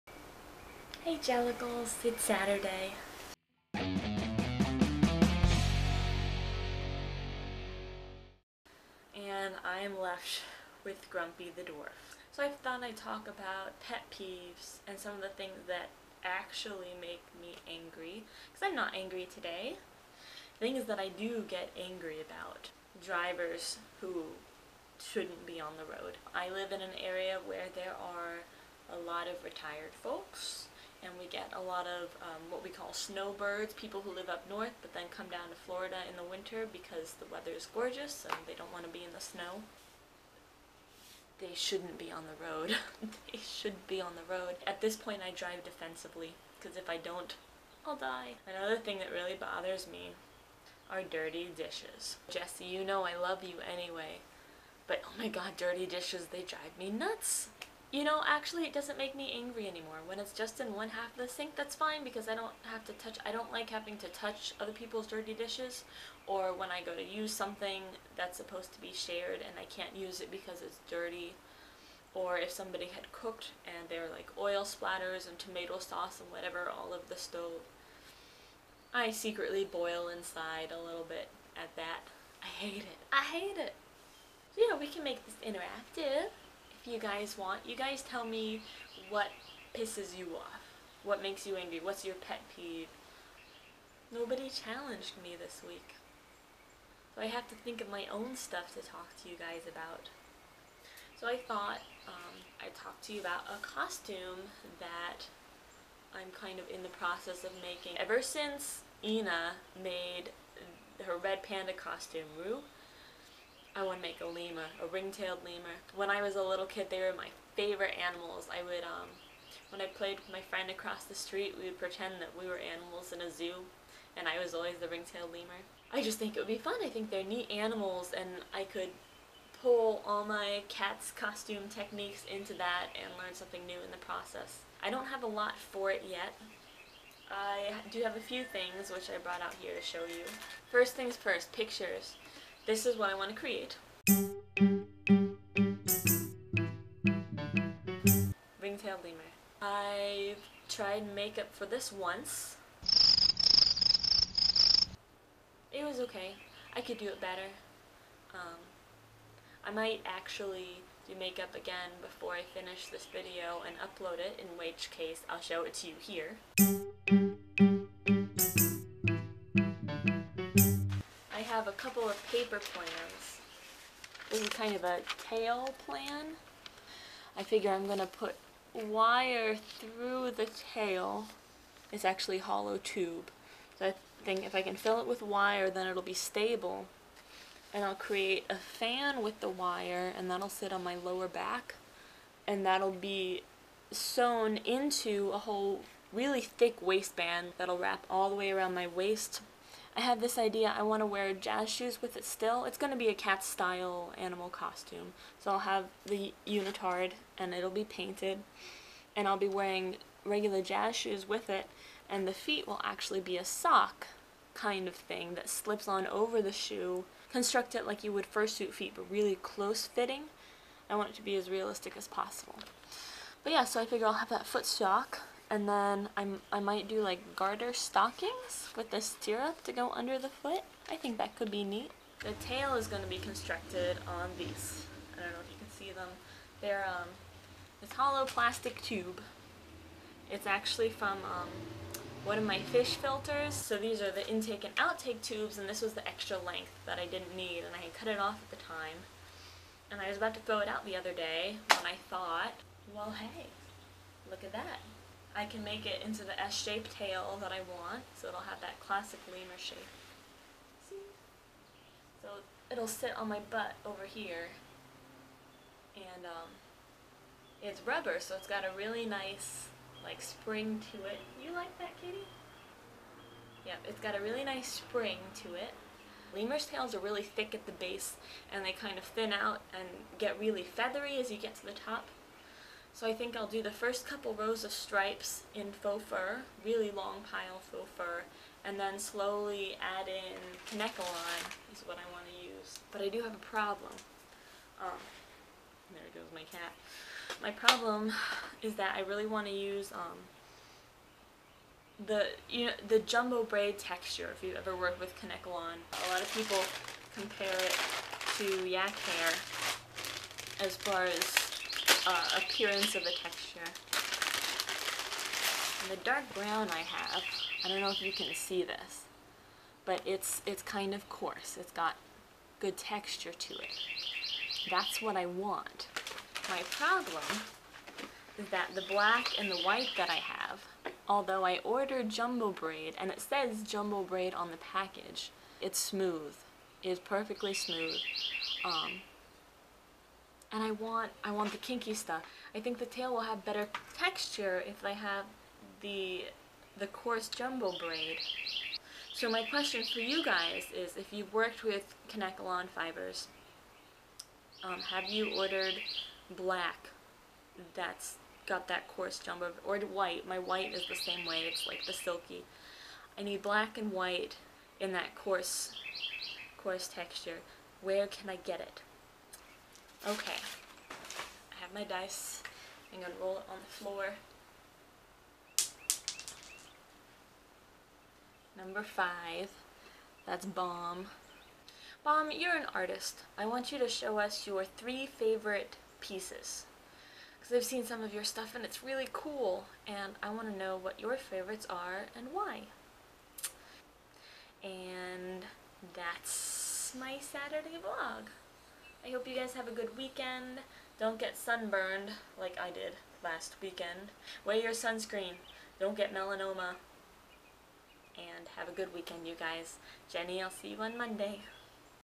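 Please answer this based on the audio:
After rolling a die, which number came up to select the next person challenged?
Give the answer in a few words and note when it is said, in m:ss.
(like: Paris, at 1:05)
5, at 6:18.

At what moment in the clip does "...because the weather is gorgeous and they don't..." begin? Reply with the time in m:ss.
0:36.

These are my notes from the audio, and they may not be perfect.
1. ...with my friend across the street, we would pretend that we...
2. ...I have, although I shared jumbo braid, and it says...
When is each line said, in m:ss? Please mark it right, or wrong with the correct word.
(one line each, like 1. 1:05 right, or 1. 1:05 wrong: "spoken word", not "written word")
1. 2:00 right
2. 5:30 wrong: "ordered", not "shared".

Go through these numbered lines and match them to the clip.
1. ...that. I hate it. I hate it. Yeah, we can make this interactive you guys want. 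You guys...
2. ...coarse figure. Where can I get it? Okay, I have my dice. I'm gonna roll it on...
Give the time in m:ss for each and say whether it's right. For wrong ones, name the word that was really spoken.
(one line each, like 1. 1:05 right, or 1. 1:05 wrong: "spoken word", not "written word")
1. 1:21 right
2. 6:06 wrong: "texture", not "figure".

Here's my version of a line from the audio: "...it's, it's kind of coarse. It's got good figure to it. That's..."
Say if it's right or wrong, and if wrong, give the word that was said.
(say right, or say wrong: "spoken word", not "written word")
wrong: "texture", not "figure".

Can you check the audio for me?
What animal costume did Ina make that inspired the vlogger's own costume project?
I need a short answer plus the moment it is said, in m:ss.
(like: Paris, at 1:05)
Red panda, at 1:51.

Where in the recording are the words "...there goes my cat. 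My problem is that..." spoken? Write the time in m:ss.
4:55.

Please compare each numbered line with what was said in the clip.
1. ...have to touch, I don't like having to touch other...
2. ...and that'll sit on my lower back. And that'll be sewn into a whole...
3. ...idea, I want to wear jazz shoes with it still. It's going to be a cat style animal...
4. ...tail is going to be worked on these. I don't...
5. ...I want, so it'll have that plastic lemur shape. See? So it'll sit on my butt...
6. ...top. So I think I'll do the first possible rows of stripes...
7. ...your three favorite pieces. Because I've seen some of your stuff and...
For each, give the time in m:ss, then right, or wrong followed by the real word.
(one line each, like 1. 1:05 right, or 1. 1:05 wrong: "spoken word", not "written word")
1. 1:02 right
2. 3:10 right
3. 3:20 right
4. 3:52 wrong: "constructed", not "worked"
5. 4:17 wrong: "classic", not "plastic"
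6. 4:41 wrong: "couple", not "possible"
7. 6:24 right.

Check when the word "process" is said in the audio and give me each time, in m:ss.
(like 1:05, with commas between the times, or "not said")
1:46, 2:14.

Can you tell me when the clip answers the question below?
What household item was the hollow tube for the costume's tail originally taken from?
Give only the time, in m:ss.
4:02.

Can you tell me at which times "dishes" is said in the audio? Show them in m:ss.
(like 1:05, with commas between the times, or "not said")
0:51, 0:55, 1:05.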